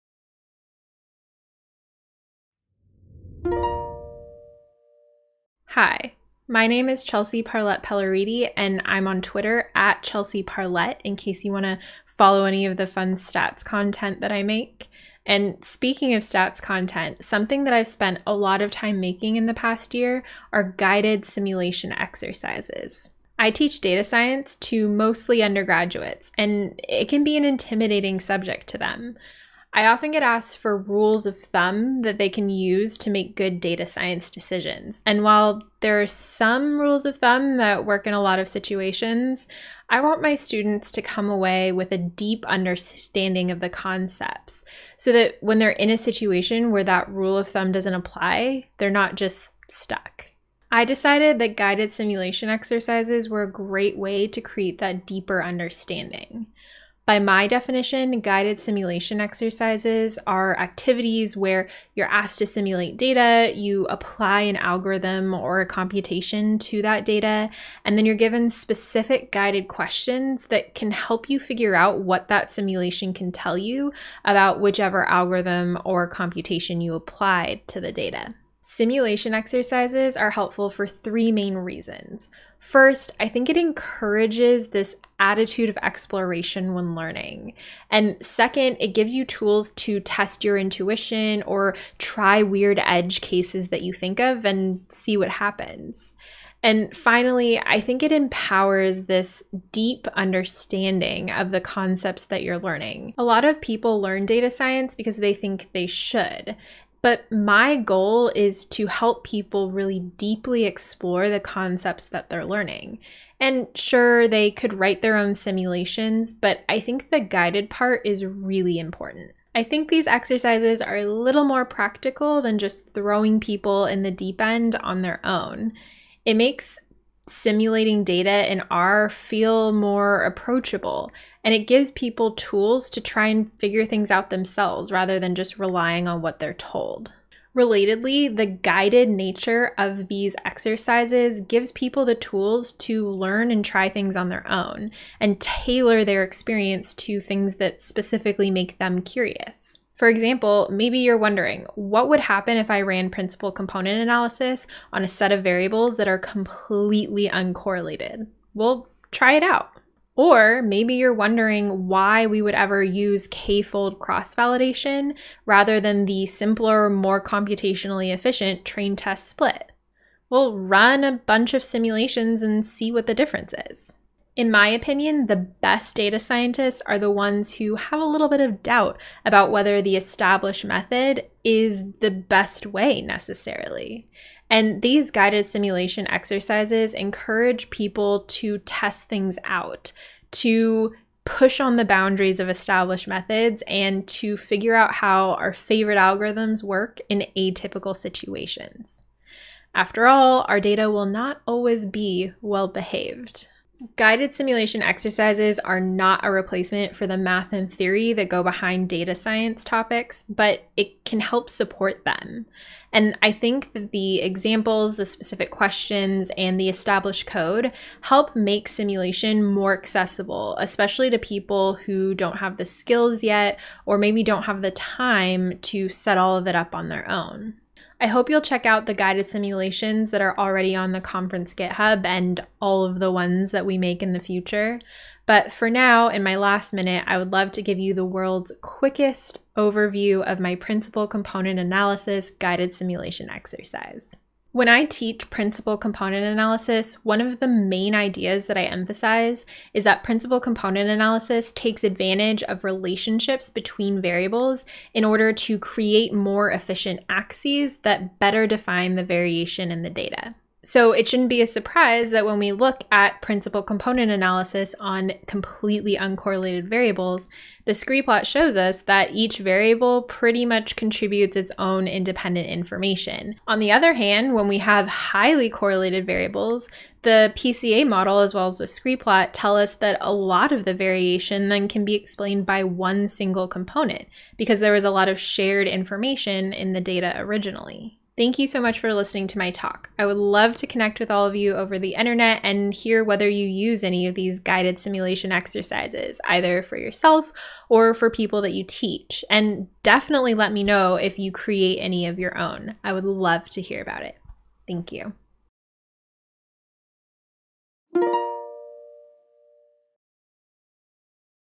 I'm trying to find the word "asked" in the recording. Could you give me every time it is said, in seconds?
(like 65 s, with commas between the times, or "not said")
30 s, 62 s.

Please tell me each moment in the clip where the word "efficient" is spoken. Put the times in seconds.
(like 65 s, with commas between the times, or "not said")
168 s, 256 s.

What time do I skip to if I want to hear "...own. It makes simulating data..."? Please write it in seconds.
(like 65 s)
125 s.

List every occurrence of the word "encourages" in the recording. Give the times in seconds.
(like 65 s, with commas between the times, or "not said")
83 s, 186 s.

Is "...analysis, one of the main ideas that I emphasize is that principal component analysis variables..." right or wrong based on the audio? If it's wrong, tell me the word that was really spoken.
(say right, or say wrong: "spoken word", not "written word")
wrong: "takes", not "variables".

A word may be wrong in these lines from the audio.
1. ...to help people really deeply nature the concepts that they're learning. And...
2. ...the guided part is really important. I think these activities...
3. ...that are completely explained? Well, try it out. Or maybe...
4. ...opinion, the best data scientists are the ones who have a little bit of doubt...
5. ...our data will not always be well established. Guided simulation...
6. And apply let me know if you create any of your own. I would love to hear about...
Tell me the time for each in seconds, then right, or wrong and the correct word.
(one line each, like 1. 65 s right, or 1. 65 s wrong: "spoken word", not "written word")
1. 108 s wrong: "explore", not "nature"
2. 117 s wrong: "exercises", not "activities"
3. 155 s wrong: "uncorrelated", not "explained"
4. 174 s right
5. 200 s wrong: "behaved", not "established"
6. 299 s wrong: "definitely", not "apply".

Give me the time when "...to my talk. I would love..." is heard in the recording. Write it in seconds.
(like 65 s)
289 s.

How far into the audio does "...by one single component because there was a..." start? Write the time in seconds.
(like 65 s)
282 s.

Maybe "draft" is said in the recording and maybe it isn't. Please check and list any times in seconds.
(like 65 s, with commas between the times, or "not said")
not said.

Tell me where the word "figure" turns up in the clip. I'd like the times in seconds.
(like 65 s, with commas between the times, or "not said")
71 s, 133 s, 194 s.